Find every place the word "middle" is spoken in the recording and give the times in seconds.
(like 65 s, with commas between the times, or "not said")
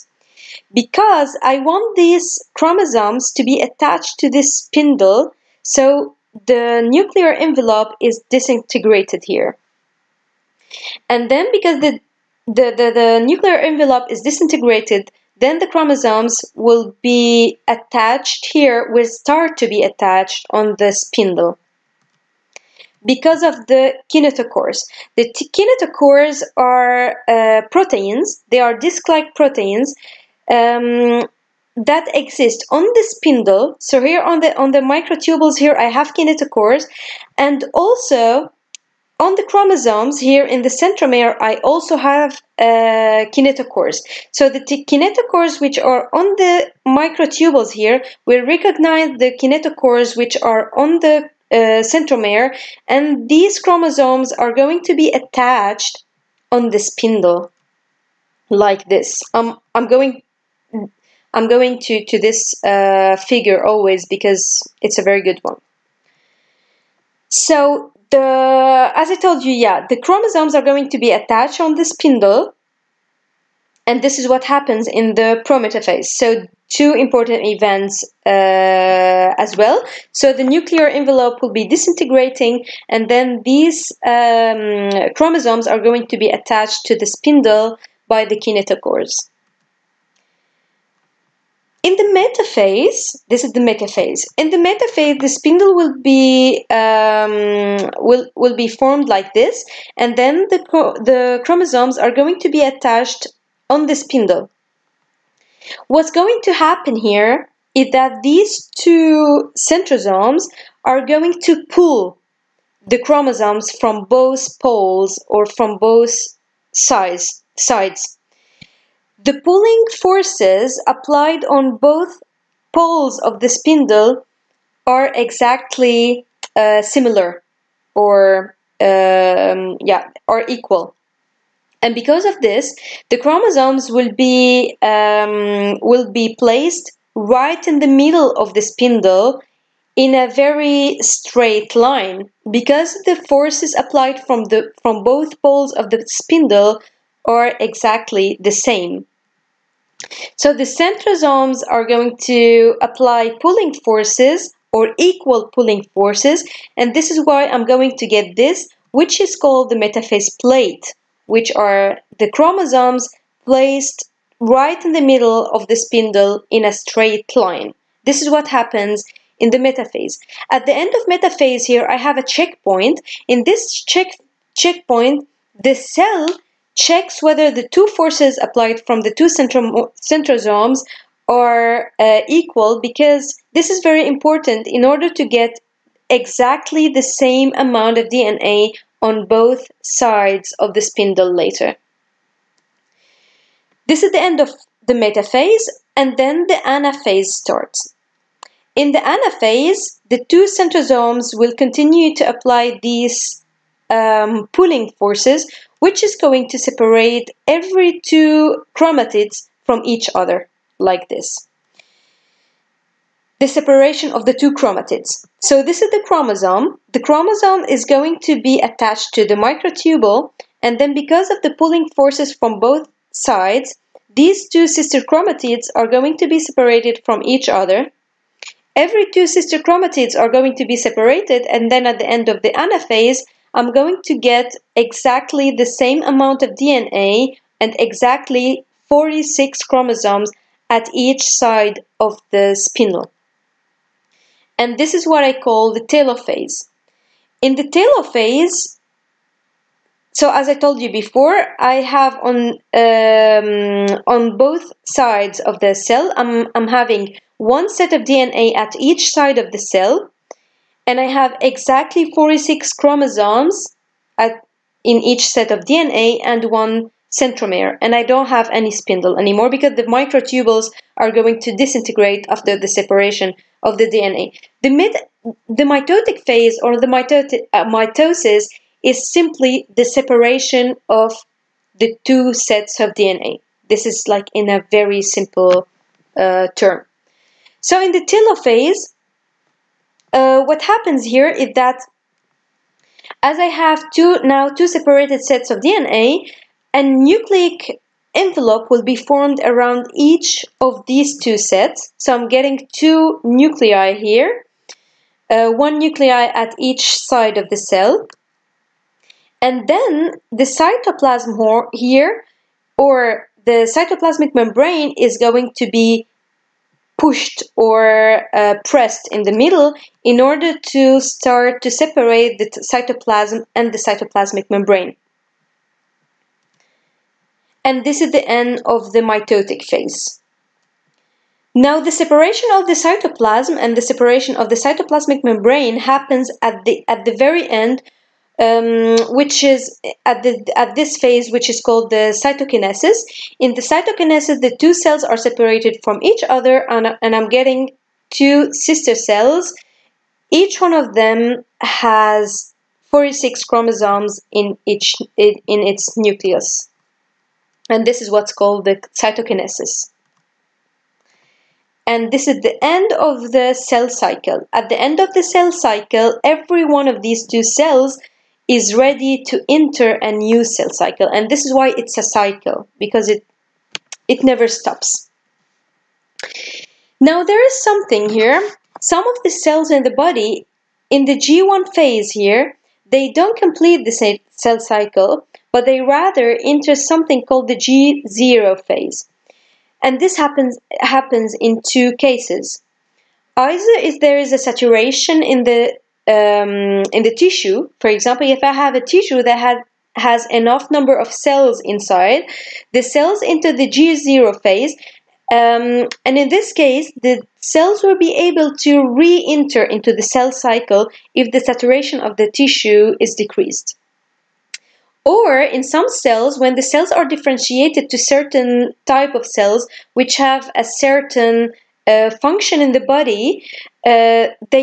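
137 s, 165 s, 319 s.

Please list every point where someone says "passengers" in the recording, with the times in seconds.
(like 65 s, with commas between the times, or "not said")
not said.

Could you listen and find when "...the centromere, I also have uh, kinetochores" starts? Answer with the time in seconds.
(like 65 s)
40 s.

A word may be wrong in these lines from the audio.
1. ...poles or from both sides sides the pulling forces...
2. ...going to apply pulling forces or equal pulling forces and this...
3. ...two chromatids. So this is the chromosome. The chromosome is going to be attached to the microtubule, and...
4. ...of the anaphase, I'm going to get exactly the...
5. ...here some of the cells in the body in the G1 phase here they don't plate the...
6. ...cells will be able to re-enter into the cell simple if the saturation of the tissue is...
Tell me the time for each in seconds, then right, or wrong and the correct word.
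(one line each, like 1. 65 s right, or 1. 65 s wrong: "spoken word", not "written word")
1. 114 s right
2. 151 s right
3. 214 s right
4. 232 s right
5. 378 s wrong: "complete", not "plate"
6. 407 s wrong: "cycle", not "simple".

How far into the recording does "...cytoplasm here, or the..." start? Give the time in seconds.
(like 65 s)
310 s.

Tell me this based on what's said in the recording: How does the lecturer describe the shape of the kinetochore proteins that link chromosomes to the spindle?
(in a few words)
disc like.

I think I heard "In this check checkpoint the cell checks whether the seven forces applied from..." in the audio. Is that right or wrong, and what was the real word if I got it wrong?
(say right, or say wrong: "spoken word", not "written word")
wrong: "two", not "seven".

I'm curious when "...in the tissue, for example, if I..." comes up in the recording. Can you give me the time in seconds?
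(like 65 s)
396 s.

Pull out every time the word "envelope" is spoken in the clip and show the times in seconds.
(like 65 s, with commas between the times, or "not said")
7 s, 13 s, 80 s, 298 s.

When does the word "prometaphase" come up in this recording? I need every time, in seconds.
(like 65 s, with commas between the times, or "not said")
75 s.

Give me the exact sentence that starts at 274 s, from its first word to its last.
The, mit the mitotic phase or the uh, mitosis is simply the separation of the two sets of DNA.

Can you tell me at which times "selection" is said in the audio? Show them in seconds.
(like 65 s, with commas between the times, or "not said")
not said.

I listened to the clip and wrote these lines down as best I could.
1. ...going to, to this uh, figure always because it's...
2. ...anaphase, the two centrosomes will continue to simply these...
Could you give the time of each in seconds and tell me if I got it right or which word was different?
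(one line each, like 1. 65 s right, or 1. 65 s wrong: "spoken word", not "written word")
1. 61 s right
2. 198 s wrong: "apply", not "simply".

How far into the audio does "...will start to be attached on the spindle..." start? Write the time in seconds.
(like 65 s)
18 s.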